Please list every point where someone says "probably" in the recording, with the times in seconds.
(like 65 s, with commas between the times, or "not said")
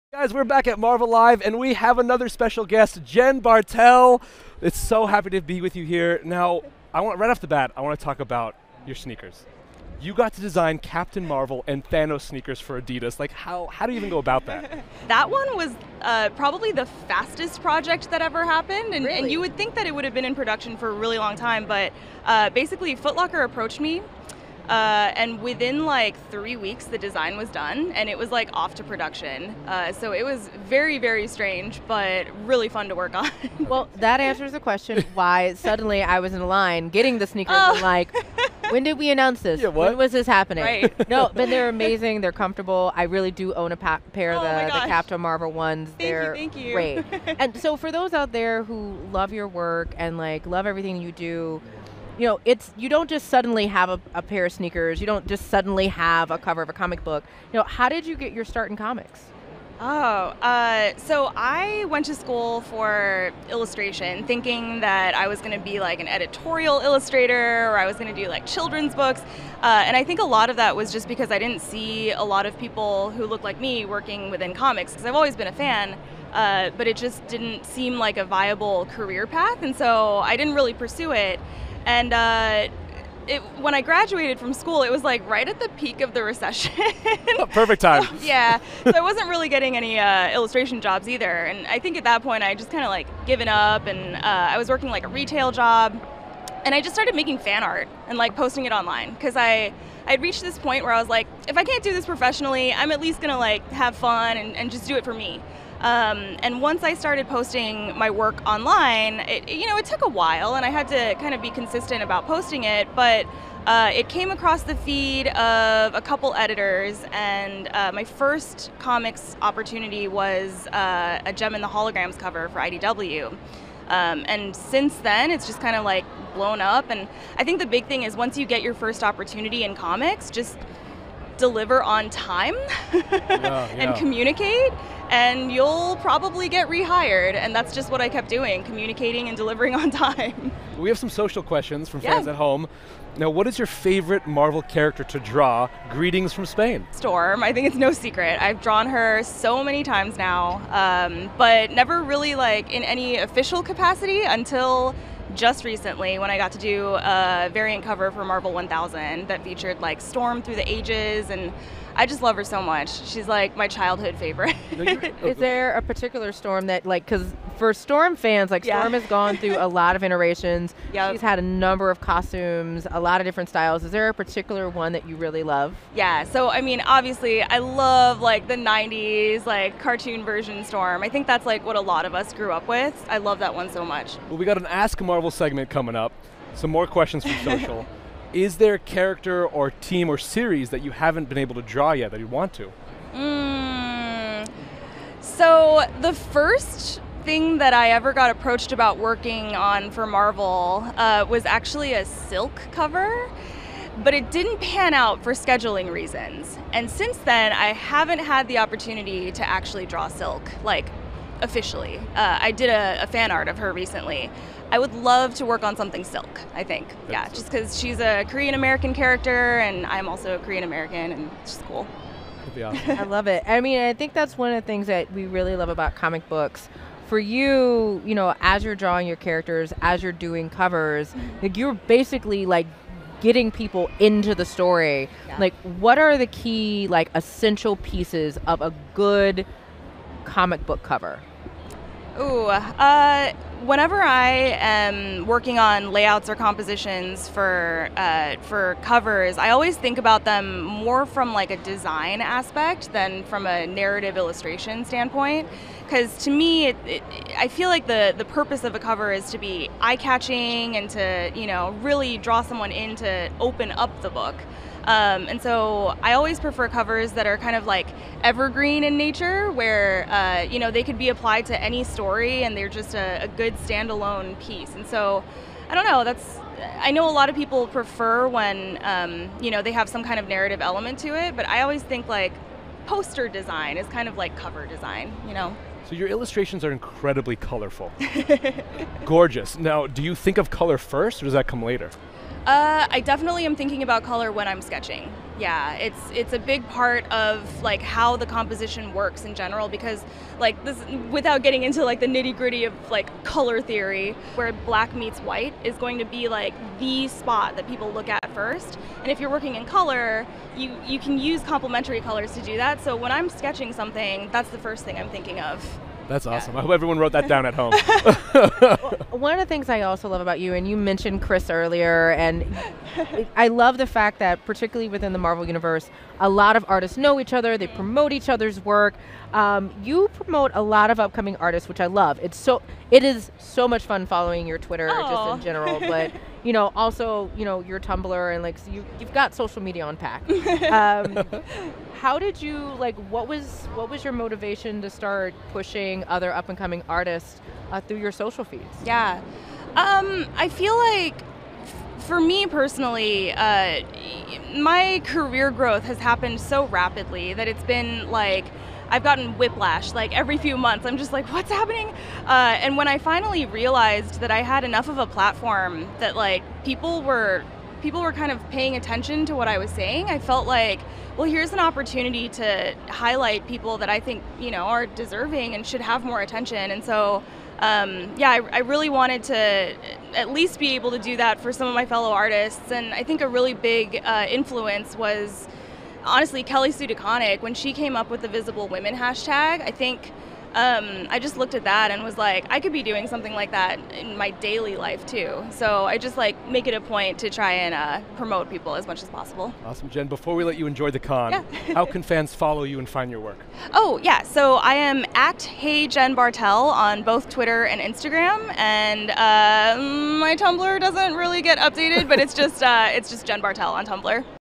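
16 s, 136 s.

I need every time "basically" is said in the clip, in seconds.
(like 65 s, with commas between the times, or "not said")
22 s, 231 s.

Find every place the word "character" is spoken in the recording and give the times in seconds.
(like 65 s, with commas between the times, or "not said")
144 s, 188 s, 218 s, 229 s.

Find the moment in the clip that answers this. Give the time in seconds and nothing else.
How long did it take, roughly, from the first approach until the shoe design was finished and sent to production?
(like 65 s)
26 s.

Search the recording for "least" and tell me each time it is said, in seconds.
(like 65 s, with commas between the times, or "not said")
103 s, 380 s.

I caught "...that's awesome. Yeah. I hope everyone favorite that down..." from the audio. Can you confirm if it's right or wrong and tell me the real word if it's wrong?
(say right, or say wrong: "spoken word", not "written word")
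wrong: "wrote", not "favorite".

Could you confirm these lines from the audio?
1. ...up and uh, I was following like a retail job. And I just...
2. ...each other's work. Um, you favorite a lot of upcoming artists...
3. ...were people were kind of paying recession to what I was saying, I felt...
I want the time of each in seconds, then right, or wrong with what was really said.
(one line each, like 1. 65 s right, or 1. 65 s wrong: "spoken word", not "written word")
1. 93 s wrong: "working", not "following"
2. 328 s wrong: "promote", not "favorite"
3. 367 s wrong: "attention", not "recession".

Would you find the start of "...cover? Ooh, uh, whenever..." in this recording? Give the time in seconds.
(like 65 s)
240 s.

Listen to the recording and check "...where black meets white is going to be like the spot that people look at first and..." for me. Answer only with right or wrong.
right.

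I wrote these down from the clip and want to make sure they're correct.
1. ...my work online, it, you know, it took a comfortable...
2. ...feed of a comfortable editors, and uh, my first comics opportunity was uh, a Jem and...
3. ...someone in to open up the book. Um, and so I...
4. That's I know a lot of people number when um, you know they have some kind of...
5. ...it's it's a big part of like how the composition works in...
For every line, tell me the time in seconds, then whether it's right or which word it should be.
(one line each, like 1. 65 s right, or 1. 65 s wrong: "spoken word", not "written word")
1. 107 s wrong: "while", not "comfortable"
2. 114 s wrong: "couple", not "comfortable"
3. 262 s right
4. 276 s wrong: "prefer", not "number"
5. 295 s right.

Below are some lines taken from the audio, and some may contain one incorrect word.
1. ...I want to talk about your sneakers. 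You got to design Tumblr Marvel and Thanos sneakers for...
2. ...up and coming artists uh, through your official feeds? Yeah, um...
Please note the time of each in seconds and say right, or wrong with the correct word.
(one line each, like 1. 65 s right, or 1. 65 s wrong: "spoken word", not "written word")
1. 7 s wrong: "Captain", not "Tumblr"
2. 346 s wrong: "social", not "official".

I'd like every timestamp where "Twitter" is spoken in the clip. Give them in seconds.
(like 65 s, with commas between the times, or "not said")
334 s, 407 s.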